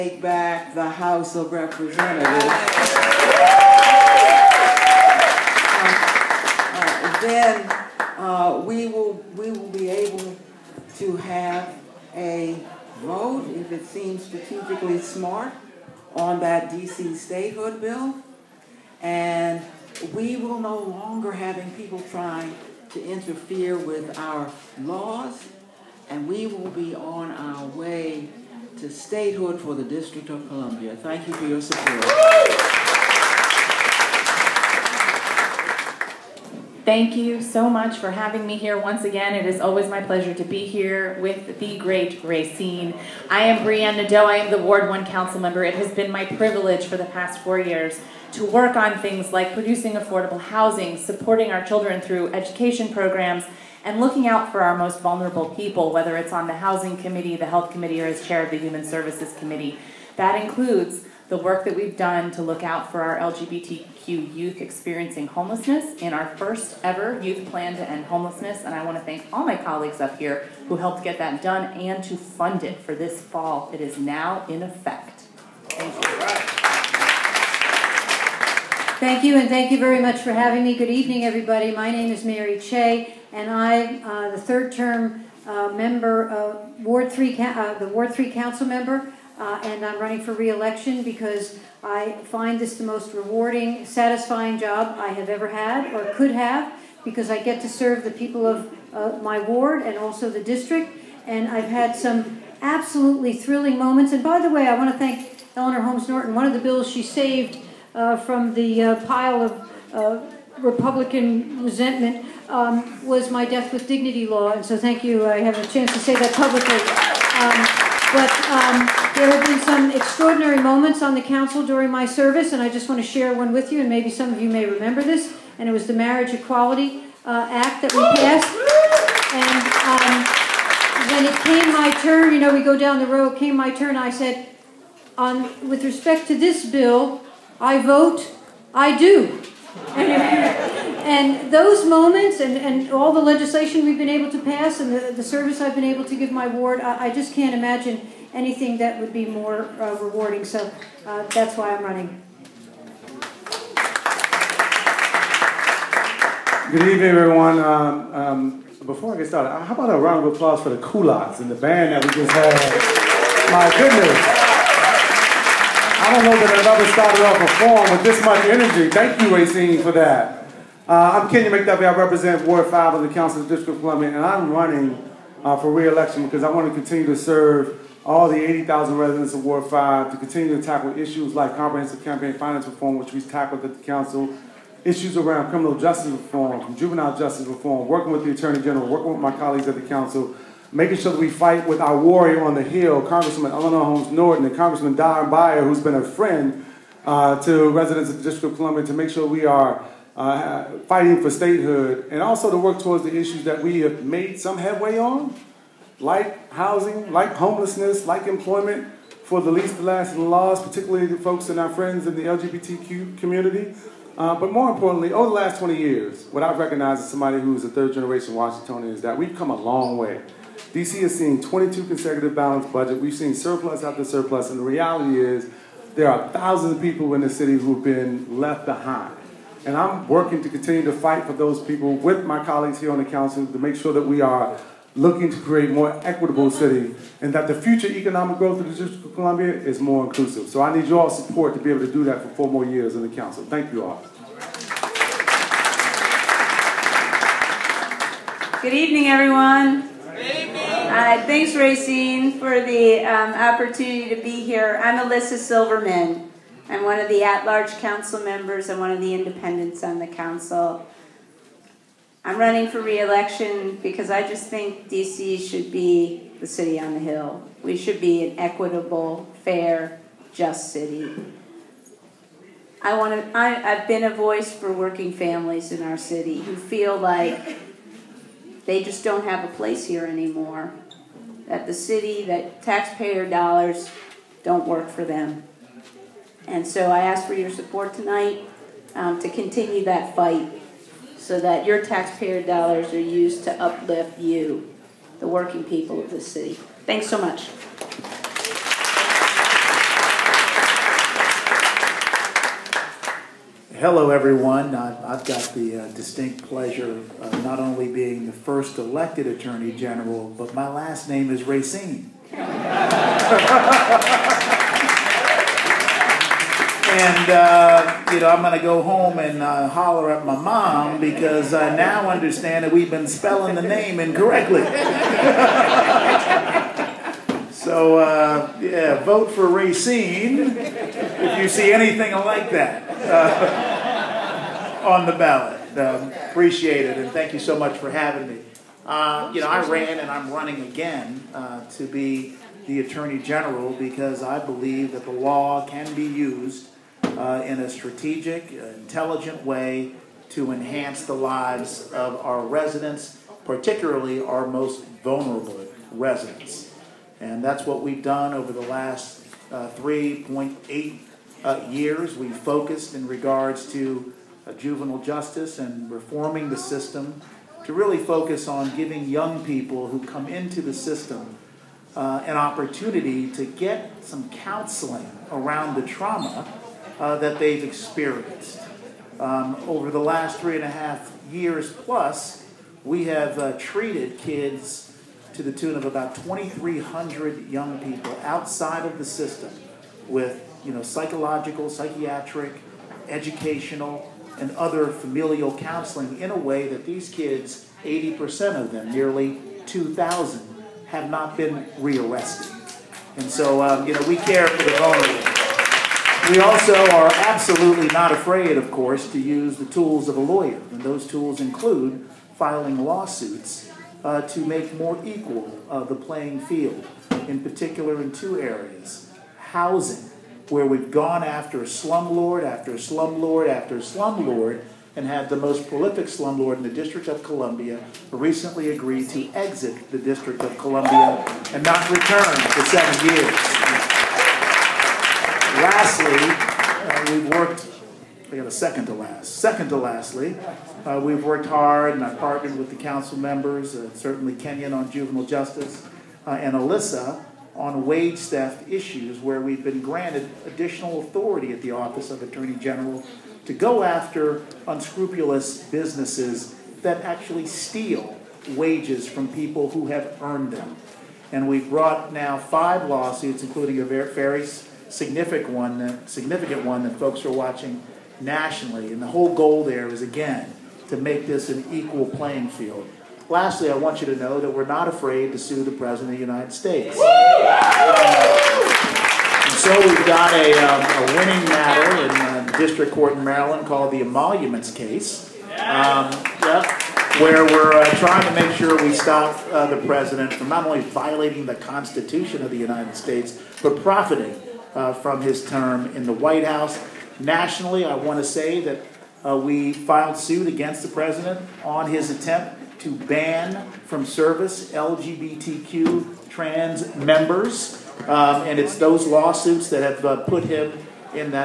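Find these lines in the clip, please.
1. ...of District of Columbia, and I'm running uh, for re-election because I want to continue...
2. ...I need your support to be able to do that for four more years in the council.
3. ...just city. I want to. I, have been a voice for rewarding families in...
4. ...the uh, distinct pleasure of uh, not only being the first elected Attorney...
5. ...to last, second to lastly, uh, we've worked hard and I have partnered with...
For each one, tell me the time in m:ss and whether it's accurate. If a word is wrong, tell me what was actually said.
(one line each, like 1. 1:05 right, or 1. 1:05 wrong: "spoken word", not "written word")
1. 2:53 right
2. 4:00 right
3. 4:30 wrong: "working", not "rewarding"
4. 5:05 right
5. 7:18 right.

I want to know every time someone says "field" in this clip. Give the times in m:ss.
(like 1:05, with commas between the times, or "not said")
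6:56, 7:52.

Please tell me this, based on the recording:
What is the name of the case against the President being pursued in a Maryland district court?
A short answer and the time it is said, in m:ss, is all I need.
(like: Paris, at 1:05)
emoluments case, at 8:04.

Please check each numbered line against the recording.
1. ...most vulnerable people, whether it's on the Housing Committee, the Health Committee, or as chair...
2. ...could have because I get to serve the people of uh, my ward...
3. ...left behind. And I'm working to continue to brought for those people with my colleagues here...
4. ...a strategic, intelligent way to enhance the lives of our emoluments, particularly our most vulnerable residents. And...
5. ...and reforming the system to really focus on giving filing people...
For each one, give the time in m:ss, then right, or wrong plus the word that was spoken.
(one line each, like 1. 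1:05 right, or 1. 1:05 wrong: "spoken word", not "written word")
1. 0:54 right
2. 1:36 right
3. 3:48 wrong: "fight", not "brought"
4. 5:47 wrong: "residents", not "emoluments"
5. 6:05 wrong: "young", not "filing".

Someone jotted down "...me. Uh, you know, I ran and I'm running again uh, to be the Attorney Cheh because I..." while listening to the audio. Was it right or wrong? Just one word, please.
wrong.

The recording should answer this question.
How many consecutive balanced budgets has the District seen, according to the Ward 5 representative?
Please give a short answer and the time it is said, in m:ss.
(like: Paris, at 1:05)
22, at 3:41.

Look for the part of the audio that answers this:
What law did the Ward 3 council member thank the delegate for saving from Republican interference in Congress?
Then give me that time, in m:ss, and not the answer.
1:53.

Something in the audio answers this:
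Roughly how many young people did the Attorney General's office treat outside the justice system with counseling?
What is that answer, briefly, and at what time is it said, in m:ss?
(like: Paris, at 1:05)
2,300, at 6:26.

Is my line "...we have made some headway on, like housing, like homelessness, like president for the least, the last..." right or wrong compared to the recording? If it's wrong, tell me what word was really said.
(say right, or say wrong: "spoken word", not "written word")
wrong: "employment", not "president".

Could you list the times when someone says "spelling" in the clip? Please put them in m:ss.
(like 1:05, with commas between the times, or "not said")
5:23.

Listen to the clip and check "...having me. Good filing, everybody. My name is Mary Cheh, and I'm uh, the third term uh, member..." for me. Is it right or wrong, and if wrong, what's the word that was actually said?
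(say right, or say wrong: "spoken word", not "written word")
wrong: "evening", not "filing".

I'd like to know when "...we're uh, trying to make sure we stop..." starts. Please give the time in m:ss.
8:07.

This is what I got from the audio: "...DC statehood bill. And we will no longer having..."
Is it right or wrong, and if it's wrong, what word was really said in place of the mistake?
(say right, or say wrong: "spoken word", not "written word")
right.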